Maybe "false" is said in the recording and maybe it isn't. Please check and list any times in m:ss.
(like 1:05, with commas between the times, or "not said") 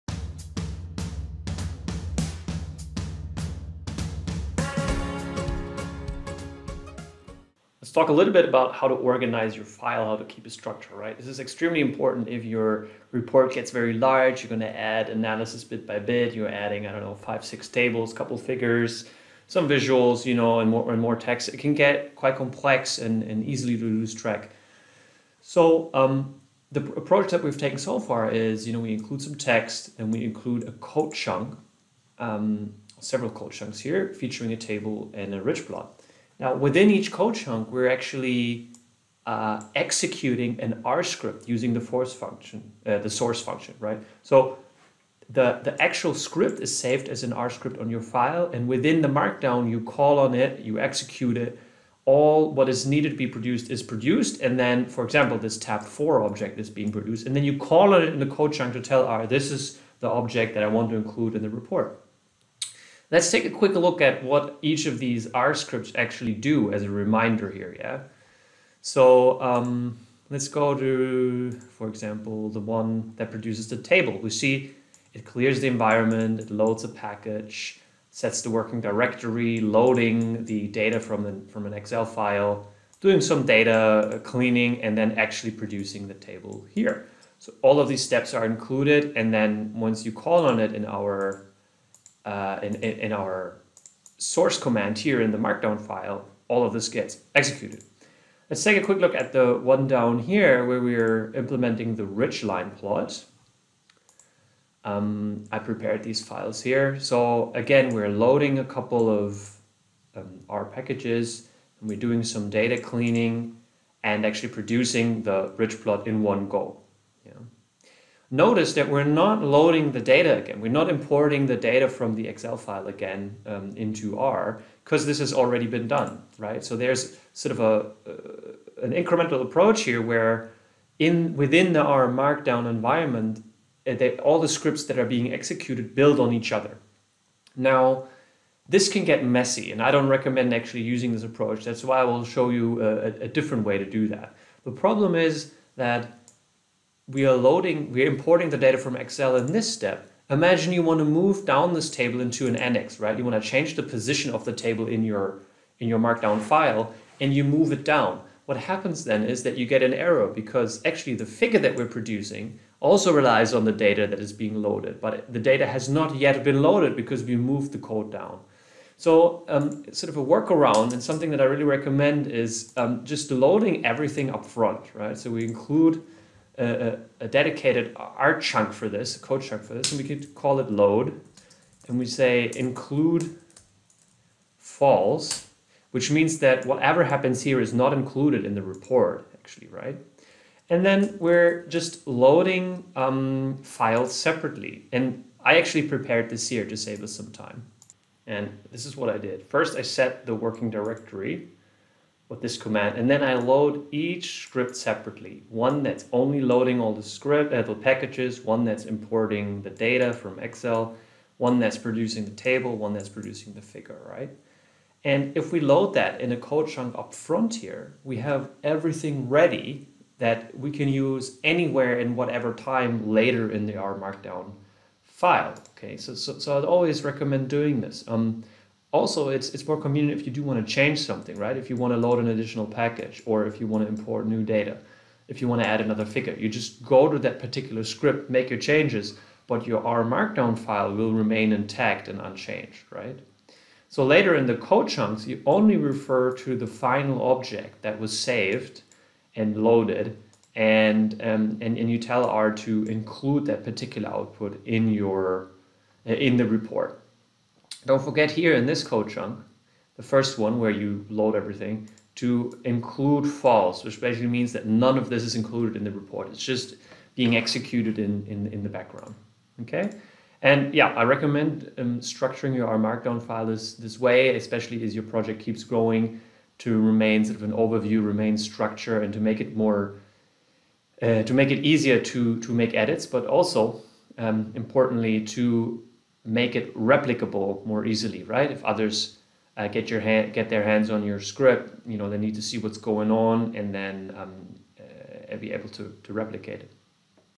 3:04, 4:23.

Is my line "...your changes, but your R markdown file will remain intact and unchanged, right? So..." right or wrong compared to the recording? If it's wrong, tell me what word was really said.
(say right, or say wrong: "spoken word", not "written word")
right.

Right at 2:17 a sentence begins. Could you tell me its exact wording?
Now, this can get messy, and I don't recommend actually using this approach.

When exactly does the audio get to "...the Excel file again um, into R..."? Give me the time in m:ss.
2:02.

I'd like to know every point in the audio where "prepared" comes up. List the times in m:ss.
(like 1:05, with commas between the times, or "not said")
1:45, 3:15.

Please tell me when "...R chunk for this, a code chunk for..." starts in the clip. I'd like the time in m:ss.
2:57.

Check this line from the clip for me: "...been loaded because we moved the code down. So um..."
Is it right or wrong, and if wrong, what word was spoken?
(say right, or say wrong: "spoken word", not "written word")
right.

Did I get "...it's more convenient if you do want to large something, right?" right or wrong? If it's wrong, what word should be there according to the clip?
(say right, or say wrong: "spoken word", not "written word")
wrong: "change", not "large".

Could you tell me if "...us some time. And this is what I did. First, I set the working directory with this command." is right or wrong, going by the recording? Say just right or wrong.
right.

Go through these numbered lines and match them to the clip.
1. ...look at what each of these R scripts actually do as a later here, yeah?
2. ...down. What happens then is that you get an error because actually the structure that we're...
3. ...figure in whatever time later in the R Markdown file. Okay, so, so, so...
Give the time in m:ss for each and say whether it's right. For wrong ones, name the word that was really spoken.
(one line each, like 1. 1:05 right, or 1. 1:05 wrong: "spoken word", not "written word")
1. 1:03 wrong: "reminder", not "later"
2. 2:37 wrong: "figure", not "structure"
3. 3:41 wrong: "anywhere", not "figure".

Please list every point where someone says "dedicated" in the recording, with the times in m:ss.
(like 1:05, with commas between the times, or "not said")
2:57.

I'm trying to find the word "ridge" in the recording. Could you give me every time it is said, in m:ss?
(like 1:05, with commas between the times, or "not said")
0:35, 1:55.